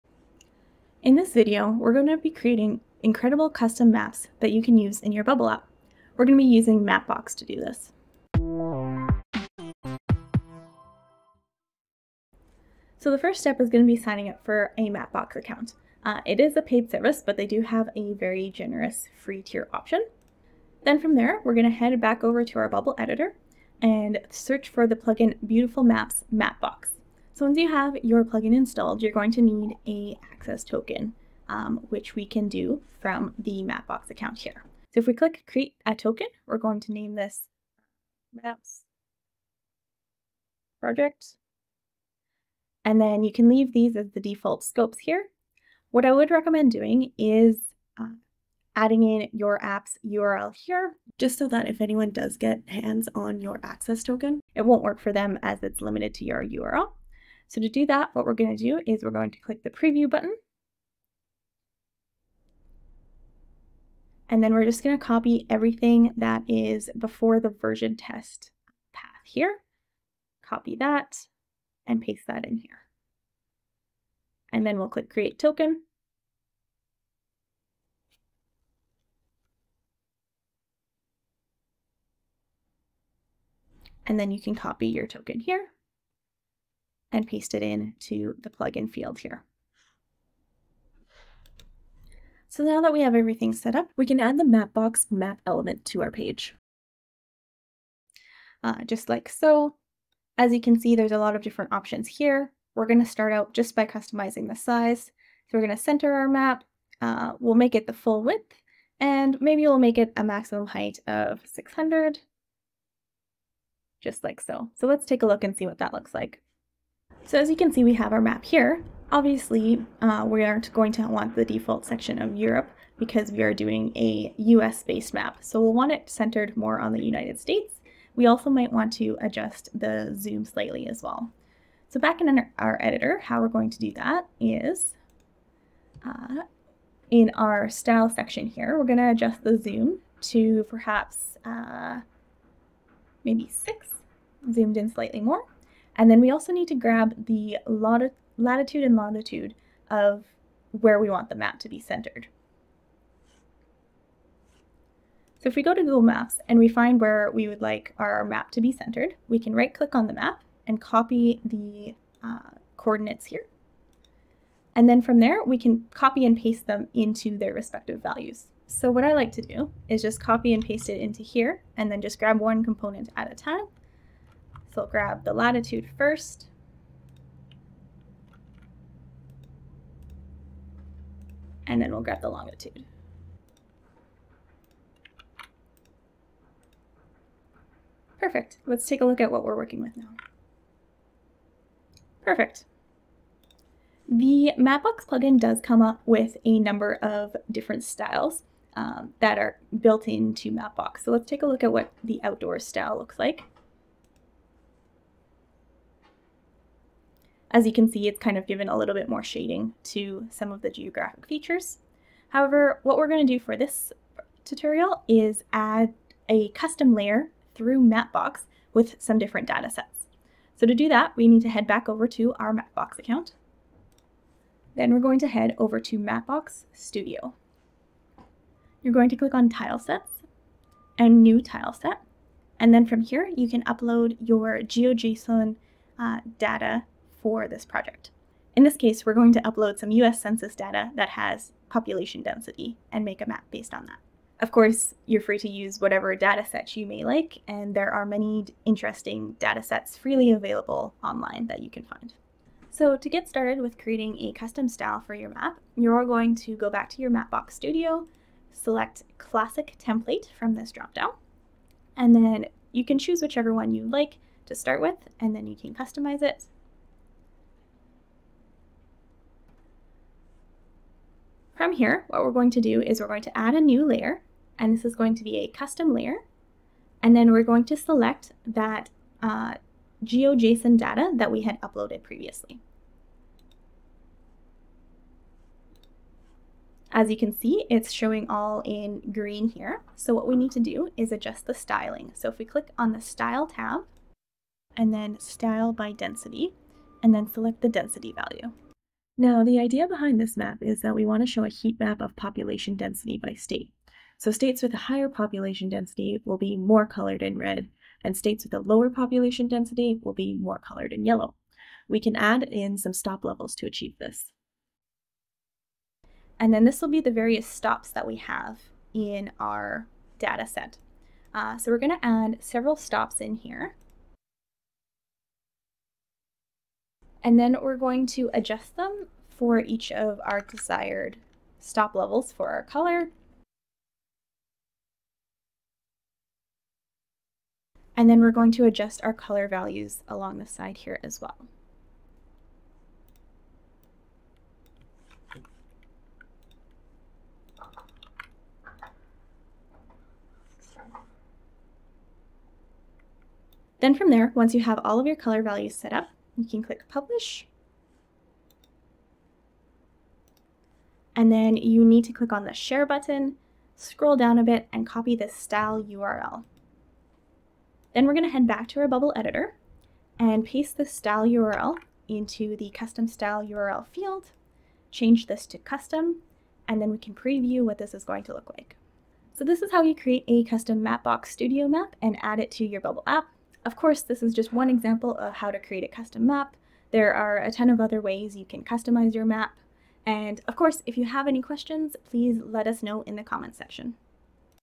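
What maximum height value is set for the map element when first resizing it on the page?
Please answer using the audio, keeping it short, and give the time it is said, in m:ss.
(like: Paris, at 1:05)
600, at 1:51.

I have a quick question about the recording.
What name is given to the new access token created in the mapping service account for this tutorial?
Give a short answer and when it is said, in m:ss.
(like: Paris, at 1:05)
Maps project, at 0:38.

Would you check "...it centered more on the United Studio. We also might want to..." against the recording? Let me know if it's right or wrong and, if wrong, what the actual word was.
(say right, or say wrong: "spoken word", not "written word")
wrong: "States", not "Studio".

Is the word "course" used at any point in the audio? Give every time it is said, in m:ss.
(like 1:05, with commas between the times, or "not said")
4:04, 6:23, 6:30.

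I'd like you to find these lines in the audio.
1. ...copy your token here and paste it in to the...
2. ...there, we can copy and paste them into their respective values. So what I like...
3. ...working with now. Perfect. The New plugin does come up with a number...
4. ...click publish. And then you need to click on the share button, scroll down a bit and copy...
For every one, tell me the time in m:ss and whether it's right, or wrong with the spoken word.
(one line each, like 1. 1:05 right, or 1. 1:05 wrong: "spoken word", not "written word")
1. 1:24 right
2. 2:45 right
3. 3:09 wrong: "Mapbox", not "New"
4. 5:56 right.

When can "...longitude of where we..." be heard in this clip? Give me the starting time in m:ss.
2:28.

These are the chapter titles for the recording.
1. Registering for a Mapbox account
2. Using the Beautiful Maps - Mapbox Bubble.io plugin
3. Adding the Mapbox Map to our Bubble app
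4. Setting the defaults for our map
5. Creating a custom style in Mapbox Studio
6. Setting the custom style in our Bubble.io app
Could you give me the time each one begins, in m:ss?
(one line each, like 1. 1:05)
1. 0:12
2. 0:23
3. 1:32
4. 2:06
5. 3:34
6. 6:08.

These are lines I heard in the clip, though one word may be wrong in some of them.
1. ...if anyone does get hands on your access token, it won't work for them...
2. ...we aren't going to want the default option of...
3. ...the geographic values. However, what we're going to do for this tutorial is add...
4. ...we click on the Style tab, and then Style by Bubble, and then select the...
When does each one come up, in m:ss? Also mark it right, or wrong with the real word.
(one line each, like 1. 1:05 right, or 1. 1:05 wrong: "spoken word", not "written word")
1. 0:51 right
2. 2:00 wrong: "section", not "option"
3. 3:30 wrong: "features", not "values"
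4. 4:52 wrong: "Density", not "Bubble".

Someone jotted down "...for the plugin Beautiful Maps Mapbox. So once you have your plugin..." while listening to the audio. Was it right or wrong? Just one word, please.
right.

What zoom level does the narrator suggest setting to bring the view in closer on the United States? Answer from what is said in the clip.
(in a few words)
6.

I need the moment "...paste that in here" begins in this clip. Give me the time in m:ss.
1:12.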